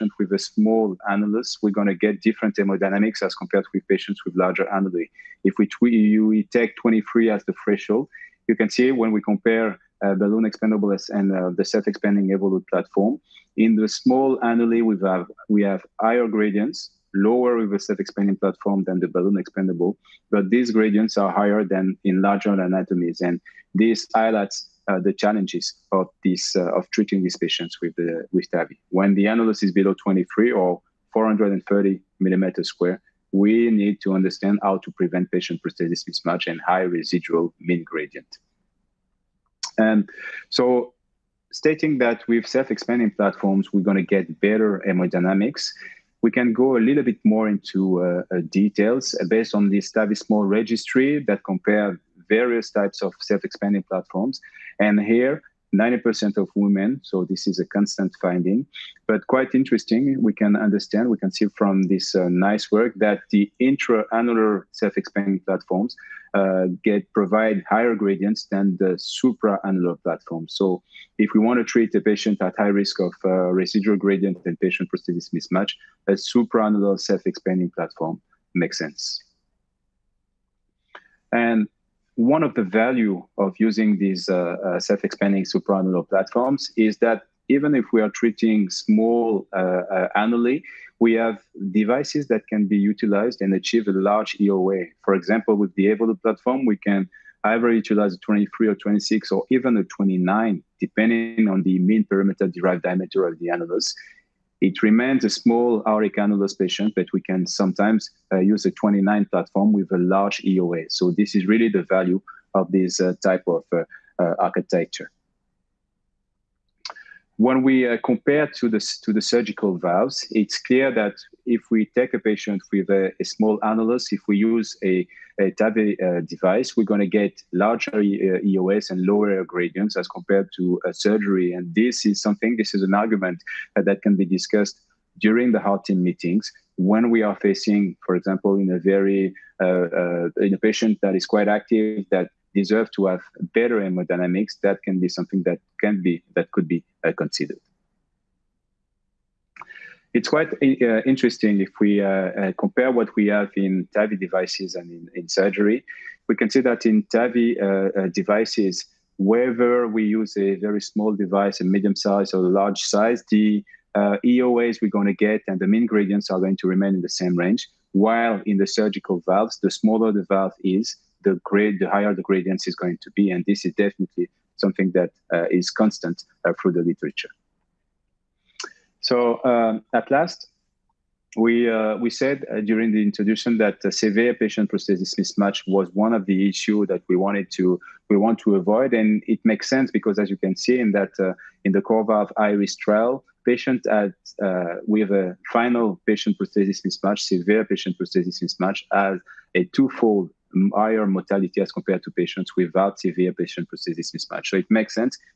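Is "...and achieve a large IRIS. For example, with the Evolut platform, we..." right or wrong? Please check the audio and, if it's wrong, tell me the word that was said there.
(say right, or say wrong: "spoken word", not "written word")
wrong: "EOA", not "IRIS".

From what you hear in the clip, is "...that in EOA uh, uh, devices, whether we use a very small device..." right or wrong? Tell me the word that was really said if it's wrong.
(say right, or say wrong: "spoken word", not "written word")
wrong: "TAVI", not "EOA".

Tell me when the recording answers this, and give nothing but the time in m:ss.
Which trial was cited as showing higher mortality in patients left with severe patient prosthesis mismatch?
3:11.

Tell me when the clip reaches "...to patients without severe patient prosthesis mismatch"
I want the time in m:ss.
3:22.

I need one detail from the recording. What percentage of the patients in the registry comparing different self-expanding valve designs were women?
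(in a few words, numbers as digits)
90%.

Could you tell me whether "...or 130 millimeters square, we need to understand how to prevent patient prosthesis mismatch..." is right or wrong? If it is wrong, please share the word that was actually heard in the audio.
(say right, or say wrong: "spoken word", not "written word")
wrong: "430", not "130".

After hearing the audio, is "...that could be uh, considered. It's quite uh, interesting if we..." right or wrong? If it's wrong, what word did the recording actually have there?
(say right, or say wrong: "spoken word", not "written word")
right.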